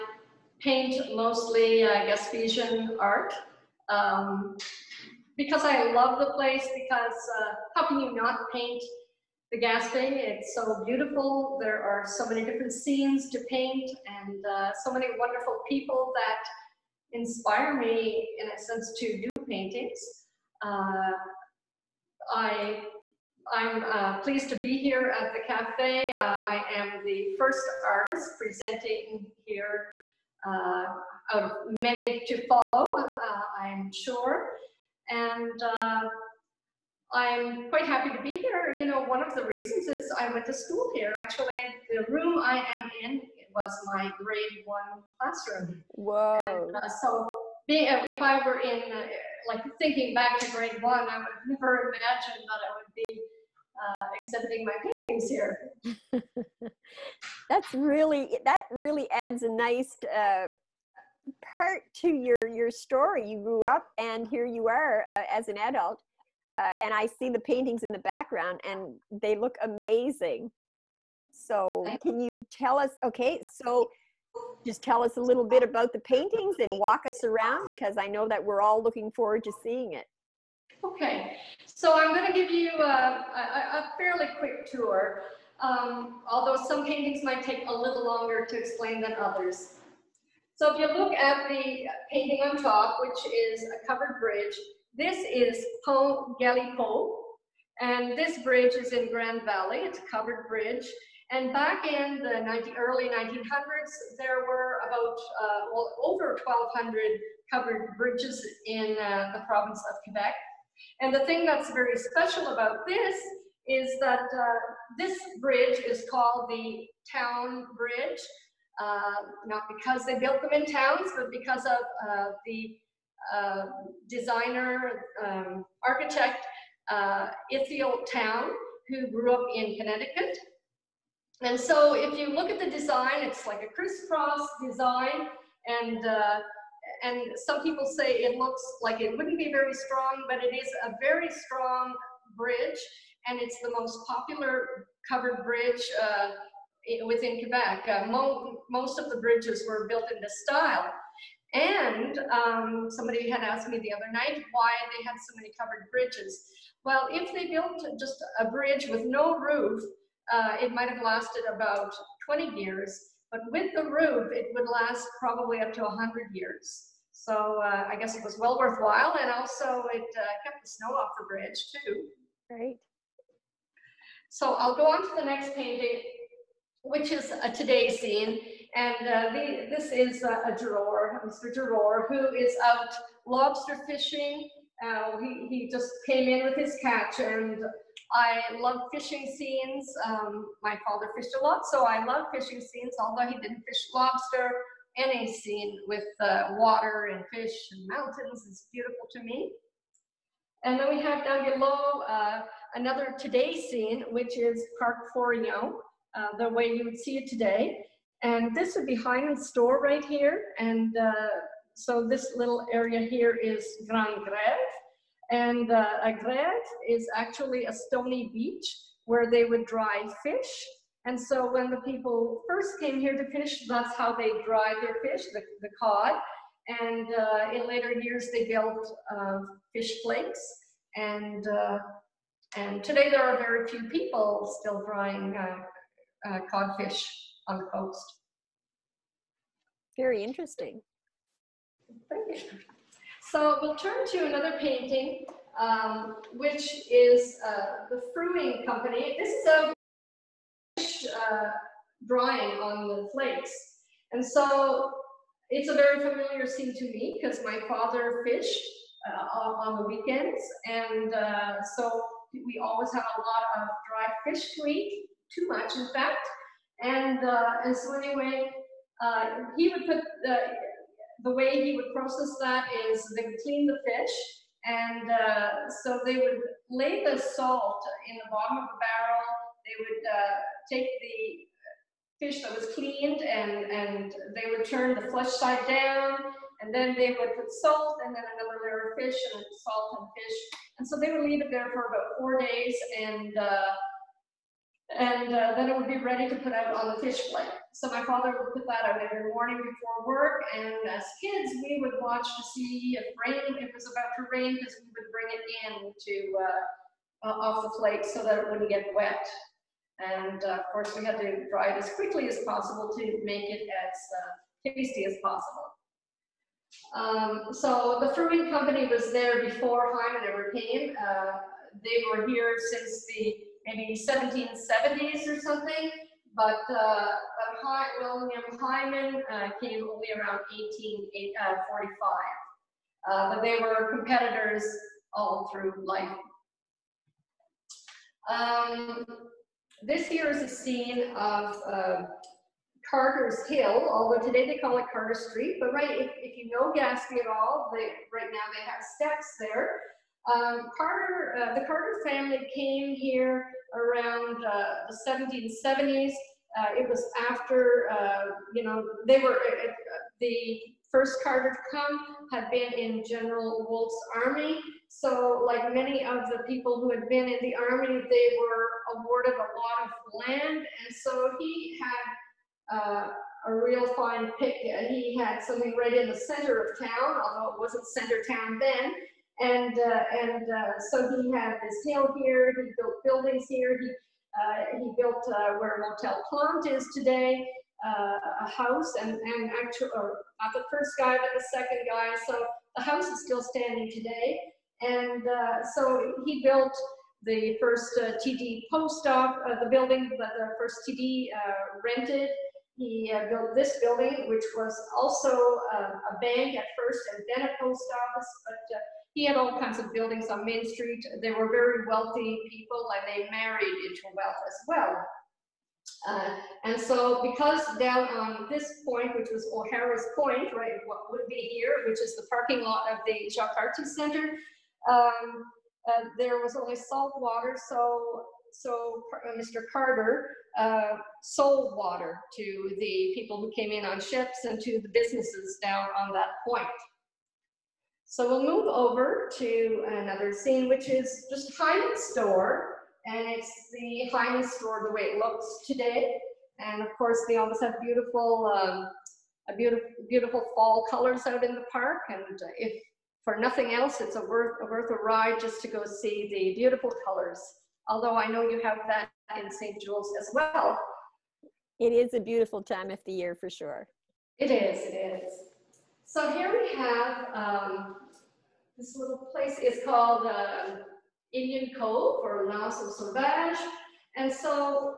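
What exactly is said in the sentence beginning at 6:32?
So the house is still standing today.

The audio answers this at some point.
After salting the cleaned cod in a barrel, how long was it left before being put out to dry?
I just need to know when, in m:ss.
4:51.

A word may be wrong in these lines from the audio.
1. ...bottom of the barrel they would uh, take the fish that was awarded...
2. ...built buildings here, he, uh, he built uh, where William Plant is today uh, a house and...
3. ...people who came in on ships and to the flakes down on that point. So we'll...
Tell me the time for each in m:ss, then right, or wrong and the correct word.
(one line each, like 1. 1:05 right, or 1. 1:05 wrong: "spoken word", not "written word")
1. 4:38 wrong: "cleaned", not "awarded"
2. 6:22 wrong: "Motel", not "William"
3. 7:13 wrong: "businesses", not "flakes".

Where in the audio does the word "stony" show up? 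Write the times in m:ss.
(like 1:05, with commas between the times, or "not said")
3:37.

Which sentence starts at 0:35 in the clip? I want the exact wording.
And uh, I'm quite happy to be here.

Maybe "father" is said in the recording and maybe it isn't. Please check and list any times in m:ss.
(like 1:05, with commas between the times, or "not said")
3:10, 4:17, 4:58.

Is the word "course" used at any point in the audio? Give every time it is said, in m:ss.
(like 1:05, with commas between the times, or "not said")
5:10, 7:26.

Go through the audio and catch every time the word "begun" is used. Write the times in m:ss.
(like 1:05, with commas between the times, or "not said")
not said.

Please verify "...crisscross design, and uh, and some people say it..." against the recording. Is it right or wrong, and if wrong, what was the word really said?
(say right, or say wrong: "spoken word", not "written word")
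right.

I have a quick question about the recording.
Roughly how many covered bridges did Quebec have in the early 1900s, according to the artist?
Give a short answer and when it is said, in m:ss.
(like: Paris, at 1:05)
over 1,200, at 1:46.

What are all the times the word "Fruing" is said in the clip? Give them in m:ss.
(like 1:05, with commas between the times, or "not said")
4:08, 5:18.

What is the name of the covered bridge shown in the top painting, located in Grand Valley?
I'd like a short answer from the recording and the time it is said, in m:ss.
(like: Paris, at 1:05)
Pont Galipeault, at 1:35.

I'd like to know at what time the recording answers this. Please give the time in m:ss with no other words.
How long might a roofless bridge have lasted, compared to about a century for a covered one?
2:42.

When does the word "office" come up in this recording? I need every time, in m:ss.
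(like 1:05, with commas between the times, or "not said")
6:39, 6:48.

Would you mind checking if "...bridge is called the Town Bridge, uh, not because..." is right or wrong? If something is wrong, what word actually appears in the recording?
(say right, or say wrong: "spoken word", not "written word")
right.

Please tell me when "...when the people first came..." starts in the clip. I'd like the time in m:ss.
3:41.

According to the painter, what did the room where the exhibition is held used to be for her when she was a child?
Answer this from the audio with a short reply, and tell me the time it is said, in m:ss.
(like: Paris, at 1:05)
grade one classroom, at 0:43.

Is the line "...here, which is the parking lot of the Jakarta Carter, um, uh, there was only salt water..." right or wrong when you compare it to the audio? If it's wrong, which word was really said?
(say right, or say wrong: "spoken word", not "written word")
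wrong: "Center", not "Carter".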